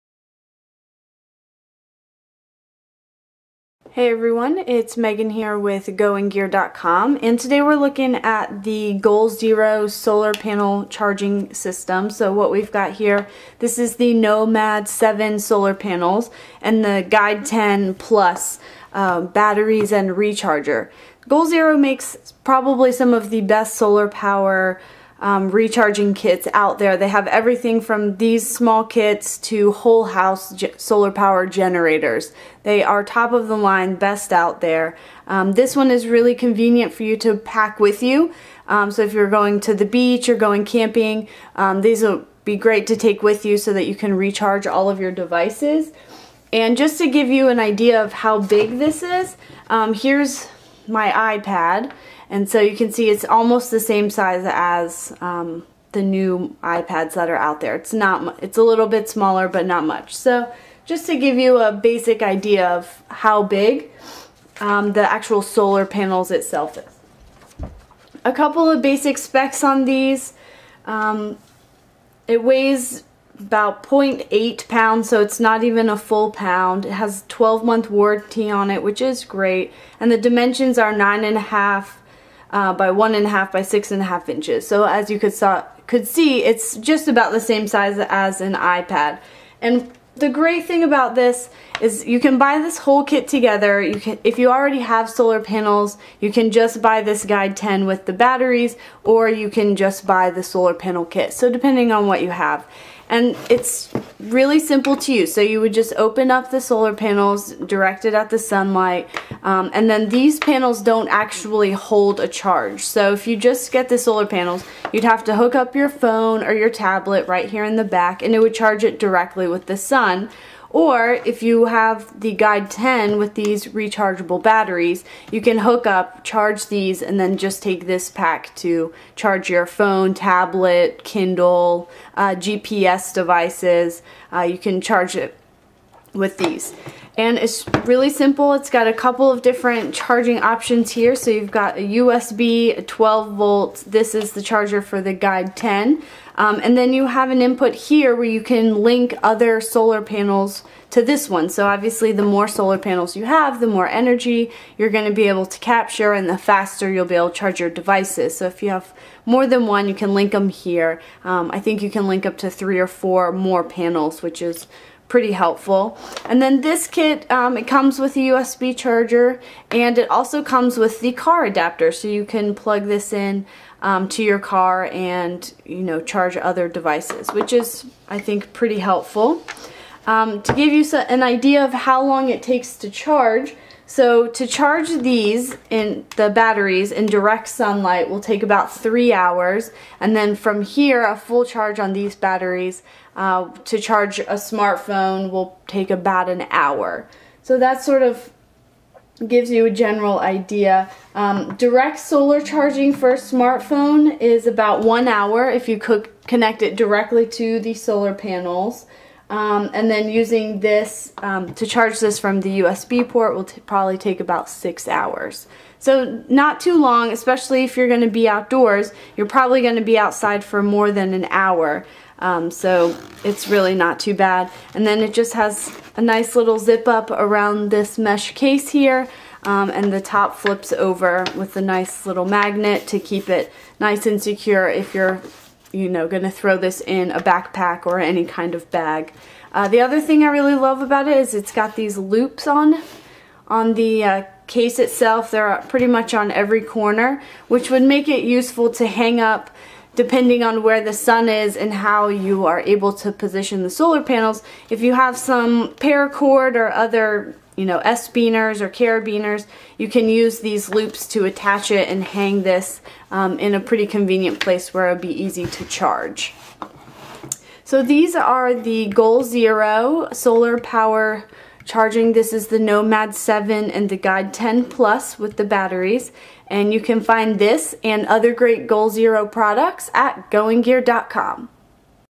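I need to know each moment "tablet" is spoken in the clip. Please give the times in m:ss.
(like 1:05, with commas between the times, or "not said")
1:56, 2:10.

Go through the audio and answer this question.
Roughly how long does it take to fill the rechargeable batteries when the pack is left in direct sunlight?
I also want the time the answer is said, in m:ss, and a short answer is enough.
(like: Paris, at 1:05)
3 hours, at 3:08.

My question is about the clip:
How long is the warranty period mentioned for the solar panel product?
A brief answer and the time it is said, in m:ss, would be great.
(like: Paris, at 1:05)
12 months, at 1:17.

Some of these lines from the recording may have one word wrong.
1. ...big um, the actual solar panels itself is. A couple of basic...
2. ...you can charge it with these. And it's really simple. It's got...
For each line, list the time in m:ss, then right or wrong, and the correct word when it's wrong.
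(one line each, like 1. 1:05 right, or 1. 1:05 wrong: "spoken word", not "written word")
1. 1:03 right
2. 2:14 right.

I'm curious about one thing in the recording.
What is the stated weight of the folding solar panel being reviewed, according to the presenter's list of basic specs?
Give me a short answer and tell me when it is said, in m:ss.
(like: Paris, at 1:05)
0.8 pounds, at 1:13.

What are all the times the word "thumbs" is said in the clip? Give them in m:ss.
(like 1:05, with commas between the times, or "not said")
not said.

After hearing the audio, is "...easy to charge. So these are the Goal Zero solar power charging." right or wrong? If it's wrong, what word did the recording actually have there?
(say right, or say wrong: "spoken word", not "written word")
right.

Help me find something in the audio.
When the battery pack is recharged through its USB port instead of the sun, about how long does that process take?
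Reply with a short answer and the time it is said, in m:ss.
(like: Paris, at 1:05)
6 hours, at 3:34.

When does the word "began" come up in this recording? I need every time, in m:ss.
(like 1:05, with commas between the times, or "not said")
not said.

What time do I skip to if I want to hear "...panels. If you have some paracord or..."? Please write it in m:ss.
4:14.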